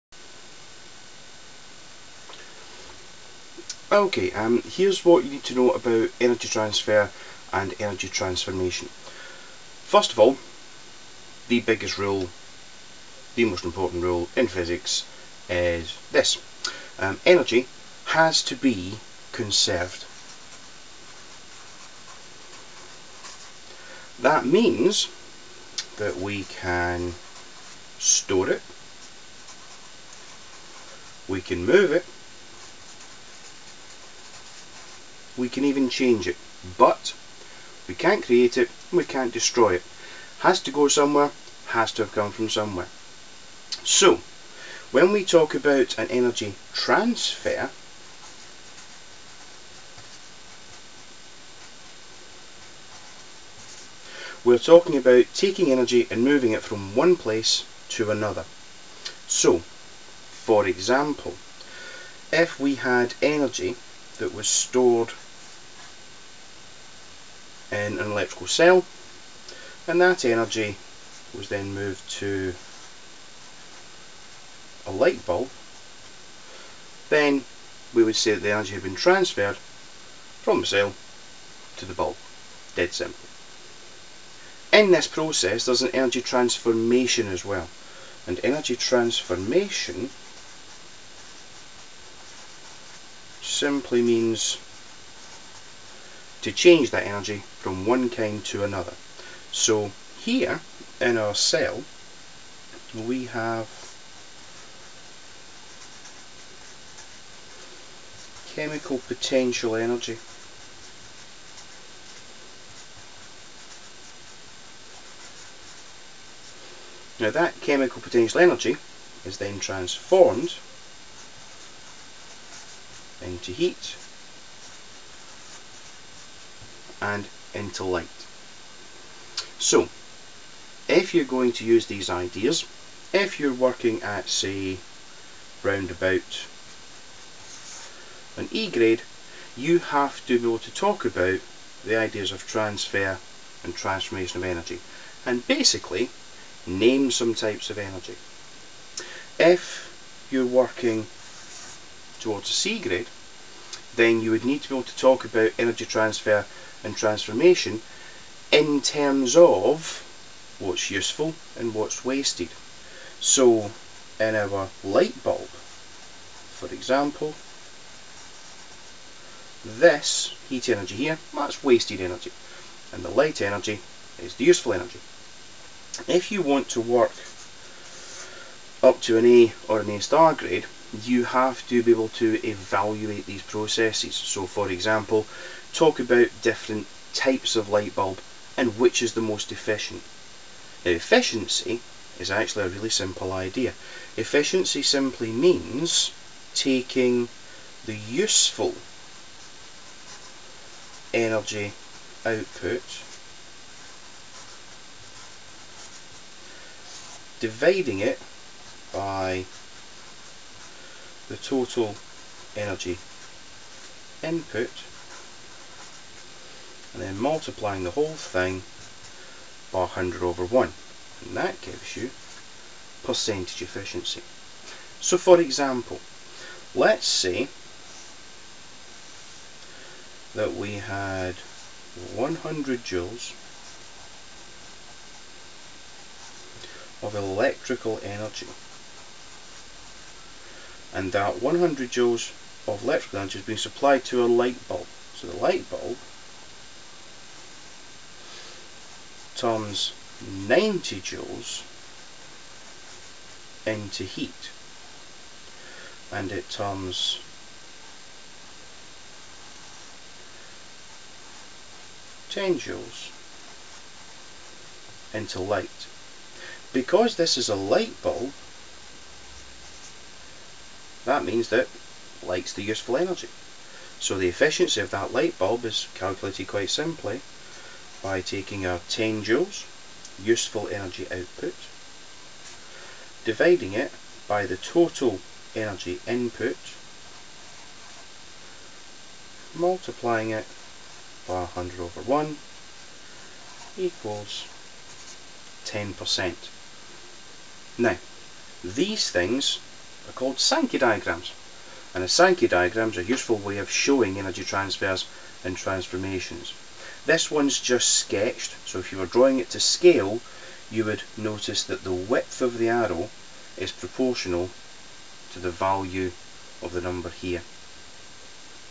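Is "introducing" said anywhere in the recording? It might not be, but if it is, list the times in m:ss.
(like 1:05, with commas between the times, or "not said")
not said.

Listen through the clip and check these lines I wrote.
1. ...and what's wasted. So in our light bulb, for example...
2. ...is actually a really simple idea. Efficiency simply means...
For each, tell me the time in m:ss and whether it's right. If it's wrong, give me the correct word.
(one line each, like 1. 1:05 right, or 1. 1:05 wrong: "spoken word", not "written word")
1. 2:41 right
2. 3:12 right.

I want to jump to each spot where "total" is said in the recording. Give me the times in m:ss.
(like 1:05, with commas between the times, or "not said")
3:31, 4:44.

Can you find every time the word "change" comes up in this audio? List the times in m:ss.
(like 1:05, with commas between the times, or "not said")
0:35, 1:36.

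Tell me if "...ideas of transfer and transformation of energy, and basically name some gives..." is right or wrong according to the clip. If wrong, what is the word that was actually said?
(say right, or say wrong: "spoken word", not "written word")
wrong: "types", not "gives".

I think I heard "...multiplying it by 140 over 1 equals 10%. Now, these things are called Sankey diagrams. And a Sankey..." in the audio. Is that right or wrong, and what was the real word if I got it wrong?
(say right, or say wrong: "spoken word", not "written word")
wrong: "100", not "140".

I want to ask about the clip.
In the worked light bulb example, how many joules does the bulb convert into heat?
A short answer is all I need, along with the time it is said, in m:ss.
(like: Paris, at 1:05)
90 joules, at 4:10.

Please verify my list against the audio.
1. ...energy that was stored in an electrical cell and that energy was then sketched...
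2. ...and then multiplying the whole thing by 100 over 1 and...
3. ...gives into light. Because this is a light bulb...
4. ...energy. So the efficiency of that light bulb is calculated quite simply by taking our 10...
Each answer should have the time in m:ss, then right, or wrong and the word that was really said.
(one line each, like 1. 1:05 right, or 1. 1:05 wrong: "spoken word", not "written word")
1. 1:03 wrong: "moved", not "sketched"
2. 3:36 right
3. 4:22 wrong: "joules", not "gives"
4. 4:32 right.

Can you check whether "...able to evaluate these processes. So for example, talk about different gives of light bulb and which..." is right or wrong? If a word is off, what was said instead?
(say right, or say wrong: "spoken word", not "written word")
wrong: "types", not "gives".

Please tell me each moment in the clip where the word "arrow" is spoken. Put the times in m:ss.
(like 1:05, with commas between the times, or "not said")
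5:12.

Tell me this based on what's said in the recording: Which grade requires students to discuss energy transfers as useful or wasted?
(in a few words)
C grade.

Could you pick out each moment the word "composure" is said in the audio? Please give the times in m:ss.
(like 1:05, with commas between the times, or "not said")
not said.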